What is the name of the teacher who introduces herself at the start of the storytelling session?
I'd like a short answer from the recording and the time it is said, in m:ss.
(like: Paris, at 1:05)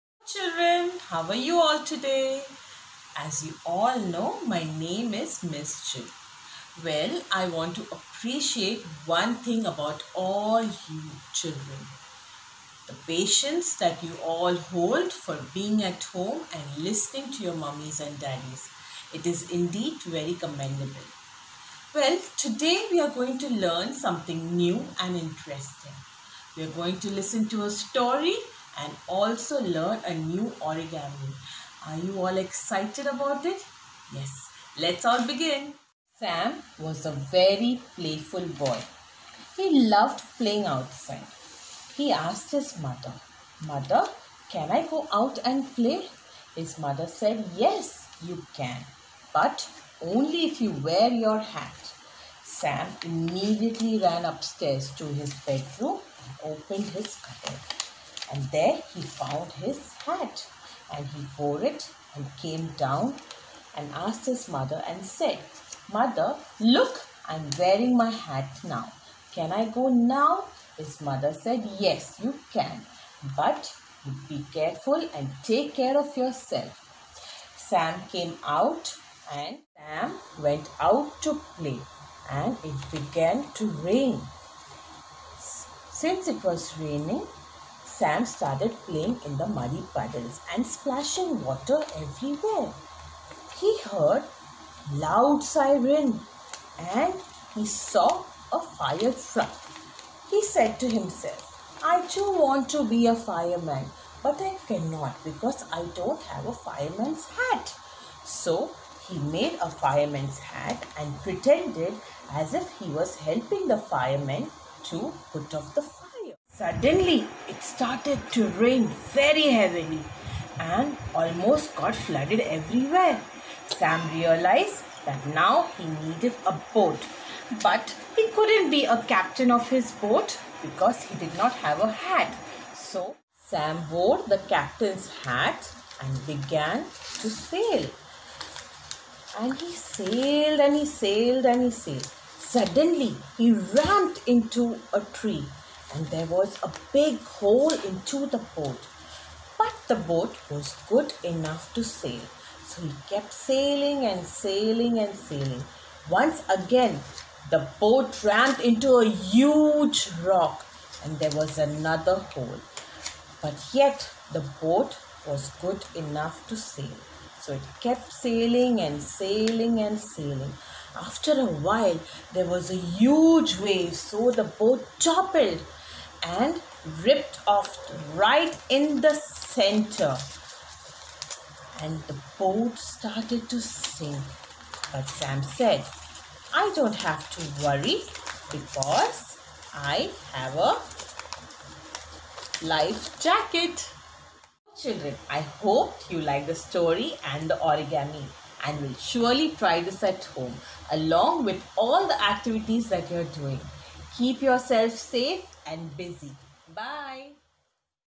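Miss Jill, at 0:05.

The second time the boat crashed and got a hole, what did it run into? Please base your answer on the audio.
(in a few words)
A huge rock.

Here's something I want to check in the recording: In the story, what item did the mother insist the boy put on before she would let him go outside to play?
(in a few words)
His hat.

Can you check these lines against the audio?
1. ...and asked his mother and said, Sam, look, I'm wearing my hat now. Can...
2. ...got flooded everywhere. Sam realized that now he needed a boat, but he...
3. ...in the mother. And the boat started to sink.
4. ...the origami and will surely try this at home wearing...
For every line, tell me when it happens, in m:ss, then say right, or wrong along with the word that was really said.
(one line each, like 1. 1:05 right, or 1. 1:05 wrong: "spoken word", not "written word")
1. 1:03 wrong: "Mother", not "Sam"
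2. 2:01 right
3. 2:58 wrong: "center", not "mother"
4. 3:17 wrong: "along", not "wearing".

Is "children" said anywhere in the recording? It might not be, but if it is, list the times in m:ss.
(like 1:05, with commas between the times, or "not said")
0:00, 0:11, 3:14.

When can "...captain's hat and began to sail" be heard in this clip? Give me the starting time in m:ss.
2:14.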